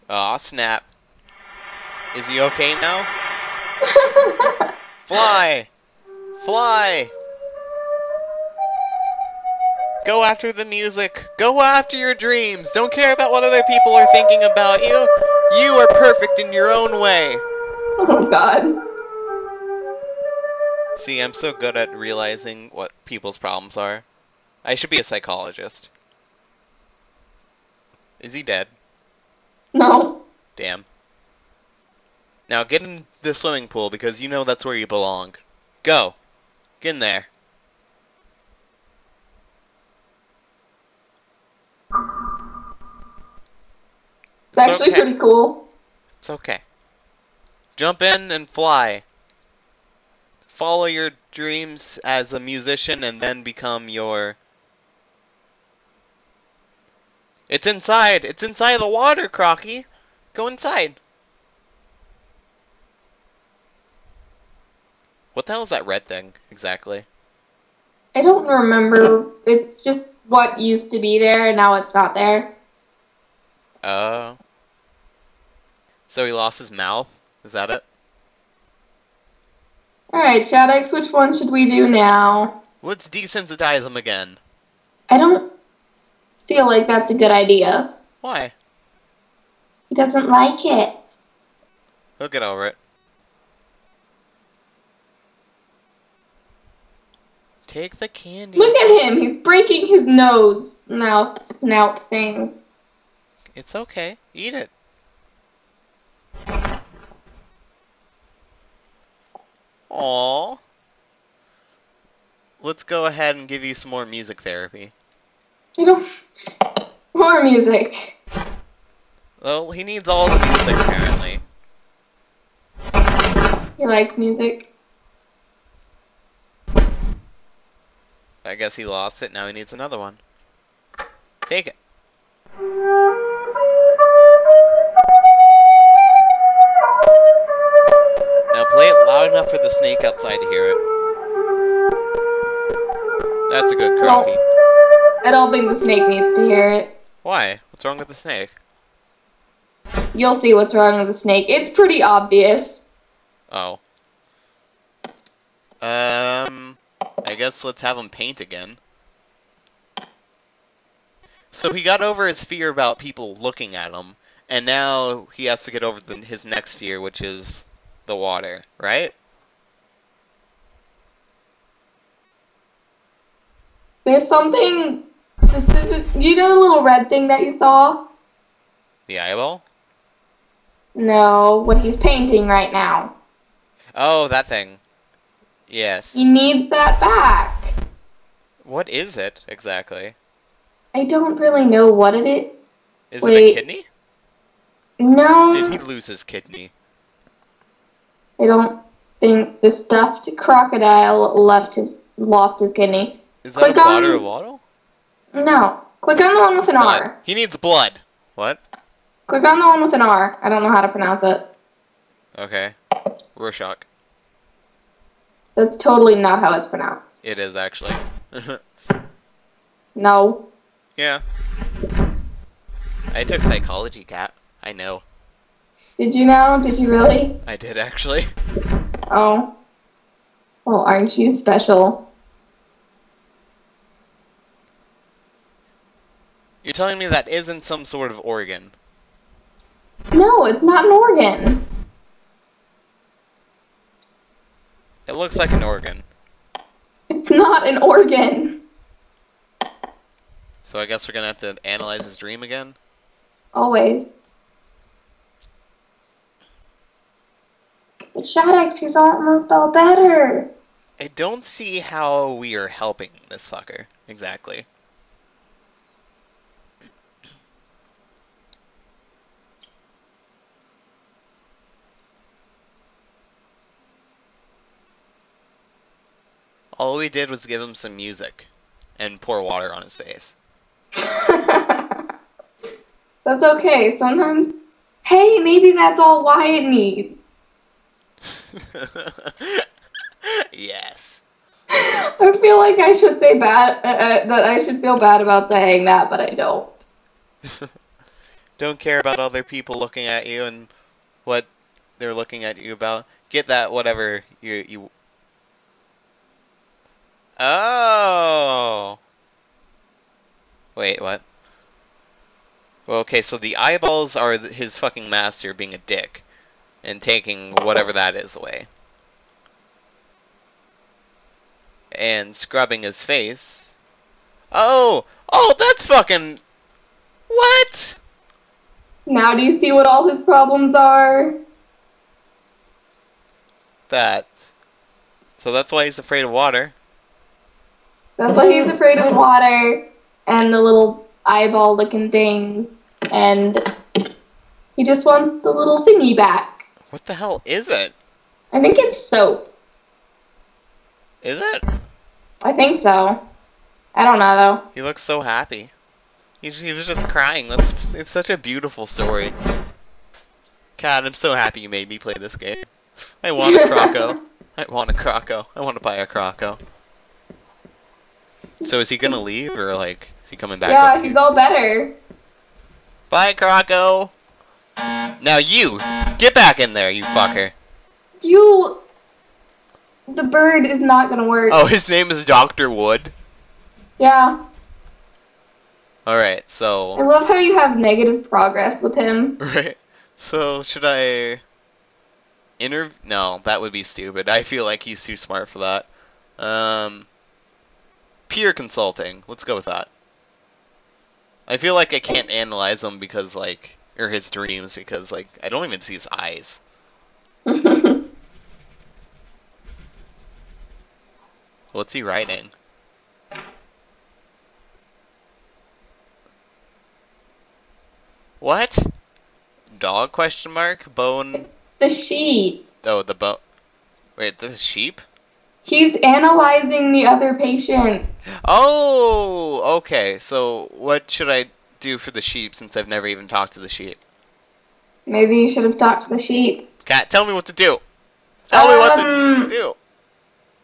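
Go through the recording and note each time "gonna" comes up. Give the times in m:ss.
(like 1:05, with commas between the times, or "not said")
4:11, 6:08, 6:21.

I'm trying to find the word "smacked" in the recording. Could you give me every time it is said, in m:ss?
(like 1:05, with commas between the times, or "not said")
not said.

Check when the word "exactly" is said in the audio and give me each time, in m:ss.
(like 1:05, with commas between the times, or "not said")
1:06, 3:09, 4:24.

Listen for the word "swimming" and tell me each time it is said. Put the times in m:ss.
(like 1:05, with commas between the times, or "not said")
0:33.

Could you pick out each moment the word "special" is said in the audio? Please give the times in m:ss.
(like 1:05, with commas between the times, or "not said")
3:51.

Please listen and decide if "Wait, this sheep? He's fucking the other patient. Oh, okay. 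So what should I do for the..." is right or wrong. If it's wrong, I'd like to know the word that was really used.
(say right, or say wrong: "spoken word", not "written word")
wrong: "analyzing", not "fucking".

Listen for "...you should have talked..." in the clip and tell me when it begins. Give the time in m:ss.
7:15.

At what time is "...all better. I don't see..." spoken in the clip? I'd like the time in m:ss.
4:19.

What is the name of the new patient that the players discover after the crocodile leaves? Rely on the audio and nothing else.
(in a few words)
Dr. Wood.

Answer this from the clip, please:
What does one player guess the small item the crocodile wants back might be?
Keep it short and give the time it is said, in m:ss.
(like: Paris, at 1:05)
Soap, at 5:49.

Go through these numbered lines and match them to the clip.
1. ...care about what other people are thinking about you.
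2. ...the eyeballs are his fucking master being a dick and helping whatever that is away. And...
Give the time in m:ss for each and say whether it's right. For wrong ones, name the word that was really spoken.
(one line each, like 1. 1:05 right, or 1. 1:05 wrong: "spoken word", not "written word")
1. 0:12 right
2. 5:13 wrong: "taking", not "helping".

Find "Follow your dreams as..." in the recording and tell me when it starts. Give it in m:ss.
0:50.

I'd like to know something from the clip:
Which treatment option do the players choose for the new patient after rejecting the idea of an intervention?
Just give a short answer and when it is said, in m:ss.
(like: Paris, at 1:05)
Peer consulting, at 6:38.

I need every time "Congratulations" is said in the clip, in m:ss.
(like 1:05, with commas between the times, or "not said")
not said.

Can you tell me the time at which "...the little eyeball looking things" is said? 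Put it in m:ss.
5:40.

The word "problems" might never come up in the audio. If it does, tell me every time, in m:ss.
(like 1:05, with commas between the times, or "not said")
0:23, 5:30.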